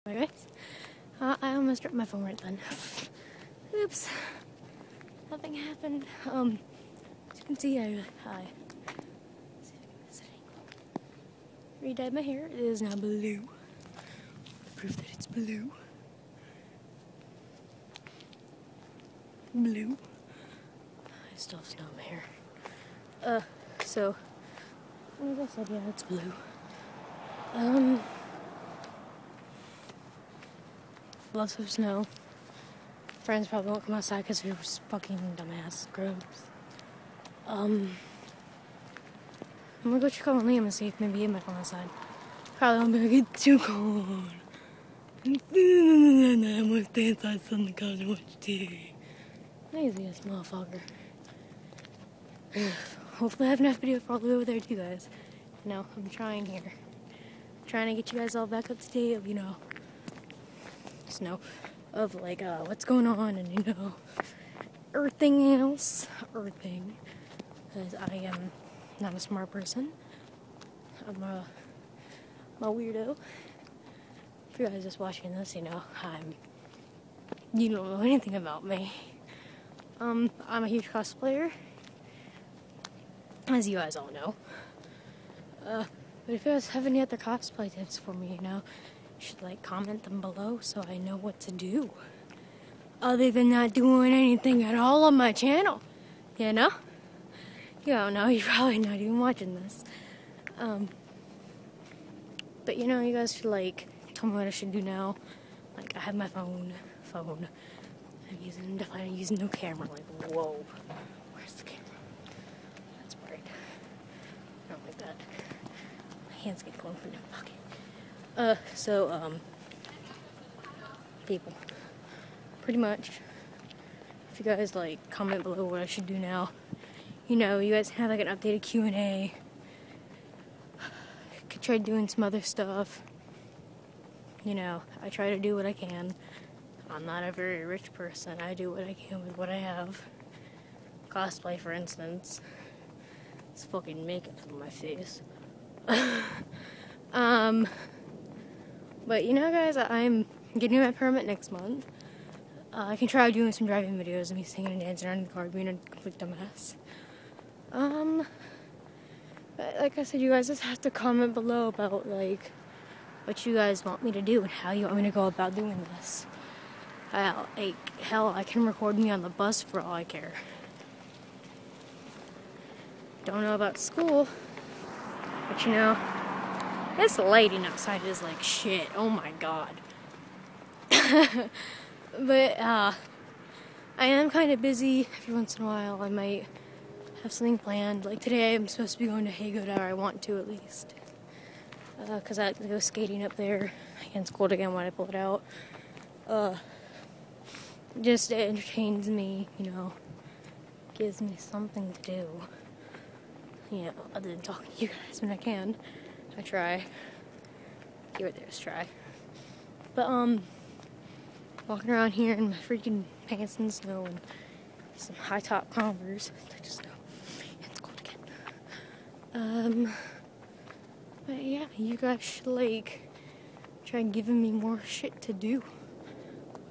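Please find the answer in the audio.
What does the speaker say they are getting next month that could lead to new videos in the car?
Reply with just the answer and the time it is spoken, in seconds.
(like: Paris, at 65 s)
Permit, at 150 s.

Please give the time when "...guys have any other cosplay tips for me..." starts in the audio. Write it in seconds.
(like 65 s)
86 s.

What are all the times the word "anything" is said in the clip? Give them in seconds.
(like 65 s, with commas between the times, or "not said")
78 s, 94 s.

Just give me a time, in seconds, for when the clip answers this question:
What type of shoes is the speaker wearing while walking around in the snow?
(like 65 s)
215 s.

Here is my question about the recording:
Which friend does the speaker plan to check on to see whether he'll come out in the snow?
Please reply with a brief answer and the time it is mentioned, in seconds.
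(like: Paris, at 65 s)
Liam, at 40 s.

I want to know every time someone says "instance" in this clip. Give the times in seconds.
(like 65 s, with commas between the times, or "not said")
141 s.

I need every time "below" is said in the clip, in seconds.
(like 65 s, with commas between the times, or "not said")
90 s, 125 s, 161 s.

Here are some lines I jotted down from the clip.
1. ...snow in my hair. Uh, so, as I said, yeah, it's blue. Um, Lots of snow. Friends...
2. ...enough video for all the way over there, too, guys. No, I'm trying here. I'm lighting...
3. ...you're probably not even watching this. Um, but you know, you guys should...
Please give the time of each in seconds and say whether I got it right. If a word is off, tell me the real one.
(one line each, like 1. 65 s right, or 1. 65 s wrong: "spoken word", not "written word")
1. 21 s right
2. 53 s wrong: "trying", not "lighting"
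3. 98 s right.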